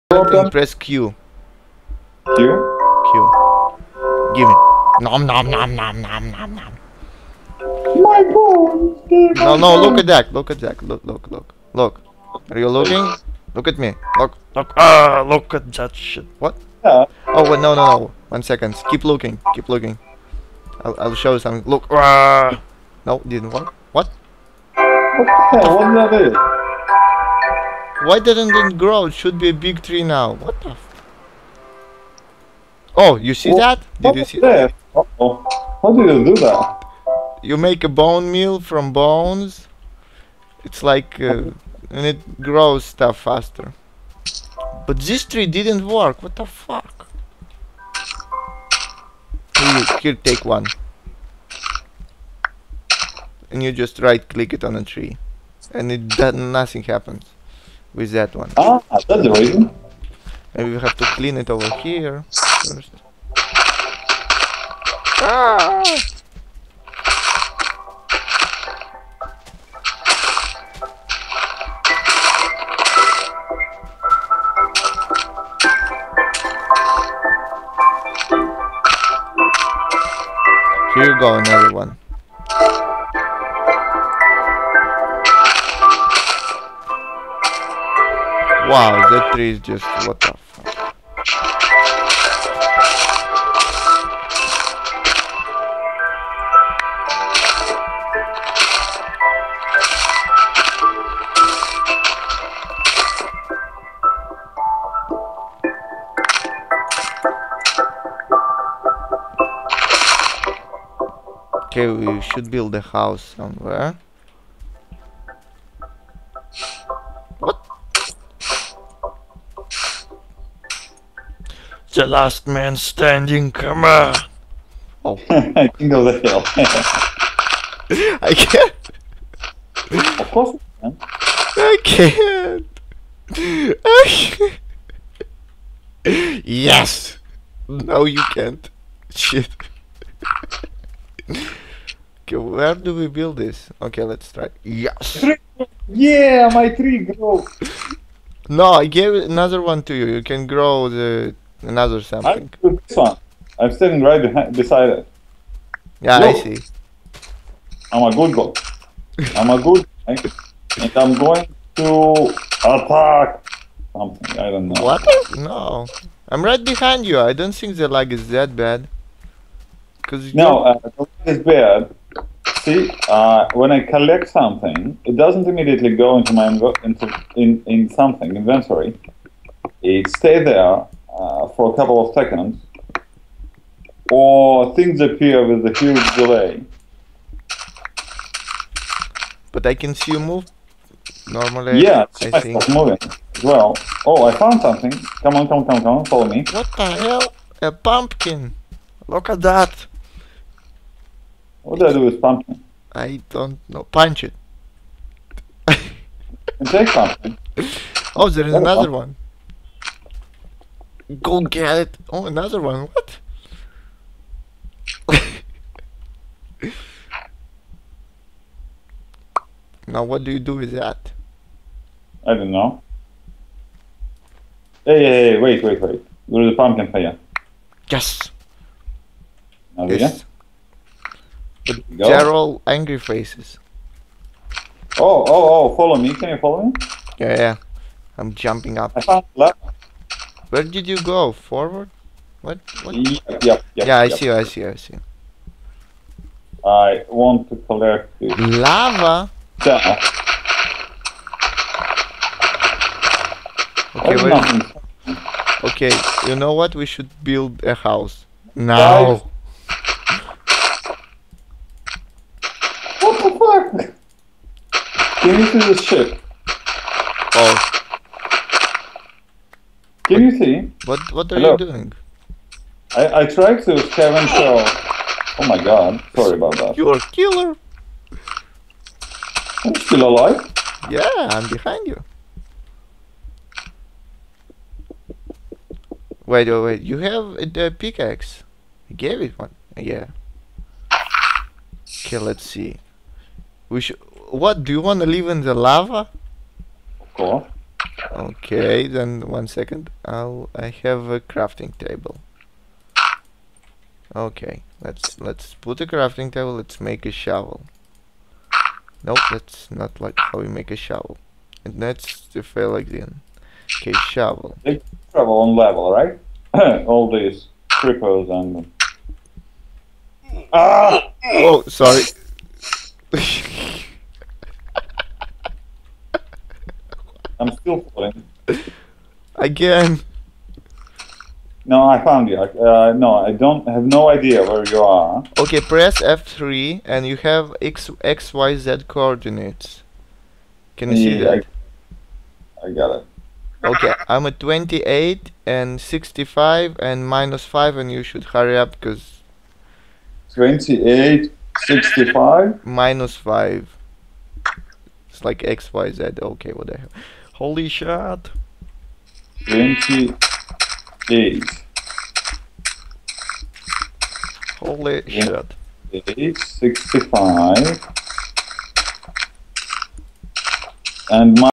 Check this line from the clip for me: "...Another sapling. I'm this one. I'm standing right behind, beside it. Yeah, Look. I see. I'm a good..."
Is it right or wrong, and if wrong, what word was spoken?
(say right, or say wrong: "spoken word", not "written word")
right.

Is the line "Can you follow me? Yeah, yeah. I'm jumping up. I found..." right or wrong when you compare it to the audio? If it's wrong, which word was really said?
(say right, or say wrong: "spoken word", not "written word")
right.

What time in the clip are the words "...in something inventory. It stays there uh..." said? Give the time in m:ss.
2:57.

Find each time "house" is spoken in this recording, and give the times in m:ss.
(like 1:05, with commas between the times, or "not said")
1:52, 4:17.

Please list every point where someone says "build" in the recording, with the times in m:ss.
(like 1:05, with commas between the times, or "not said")
1:52, 2:23, 4:17.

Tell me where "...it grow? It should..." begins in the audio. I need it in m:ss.
0:28.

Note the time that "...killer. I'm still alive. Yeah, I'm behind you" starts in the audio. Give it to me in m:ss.
4:37.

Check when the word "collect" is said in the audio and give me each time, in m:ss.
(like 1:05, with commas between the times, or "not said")
2:53, 4:07.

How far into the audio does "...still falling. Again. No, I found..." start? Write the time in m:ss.
5:27.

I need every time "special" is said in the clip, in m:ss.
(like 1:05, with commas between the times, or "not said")
not said.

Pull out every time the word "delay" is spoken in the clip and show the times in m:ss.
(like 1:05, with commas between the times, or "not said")
3:06.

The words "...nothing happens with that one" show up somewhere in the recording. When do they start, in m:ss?
0:56.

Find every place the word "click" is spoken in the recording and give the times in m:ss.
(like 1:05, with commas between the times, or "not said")
0:54.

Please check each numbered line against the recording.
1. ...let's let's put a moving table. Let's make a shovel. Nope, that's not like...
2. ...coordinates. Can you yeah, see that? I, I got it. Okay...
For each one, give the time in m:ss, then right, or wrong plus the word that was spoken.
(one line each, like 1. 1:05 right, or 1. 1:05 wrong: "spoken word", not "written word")
1. 5:04 wrong: "crafting", not "moving"
2. 5:38 right.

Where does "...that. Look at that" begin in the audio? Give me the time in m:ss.
0:10.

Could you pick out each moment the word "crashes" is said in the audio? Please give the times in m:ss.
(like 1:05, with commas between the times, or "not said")
not said.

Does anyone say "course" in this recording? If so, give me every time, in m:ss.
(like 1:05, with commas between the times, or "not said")
2:10, 4:57.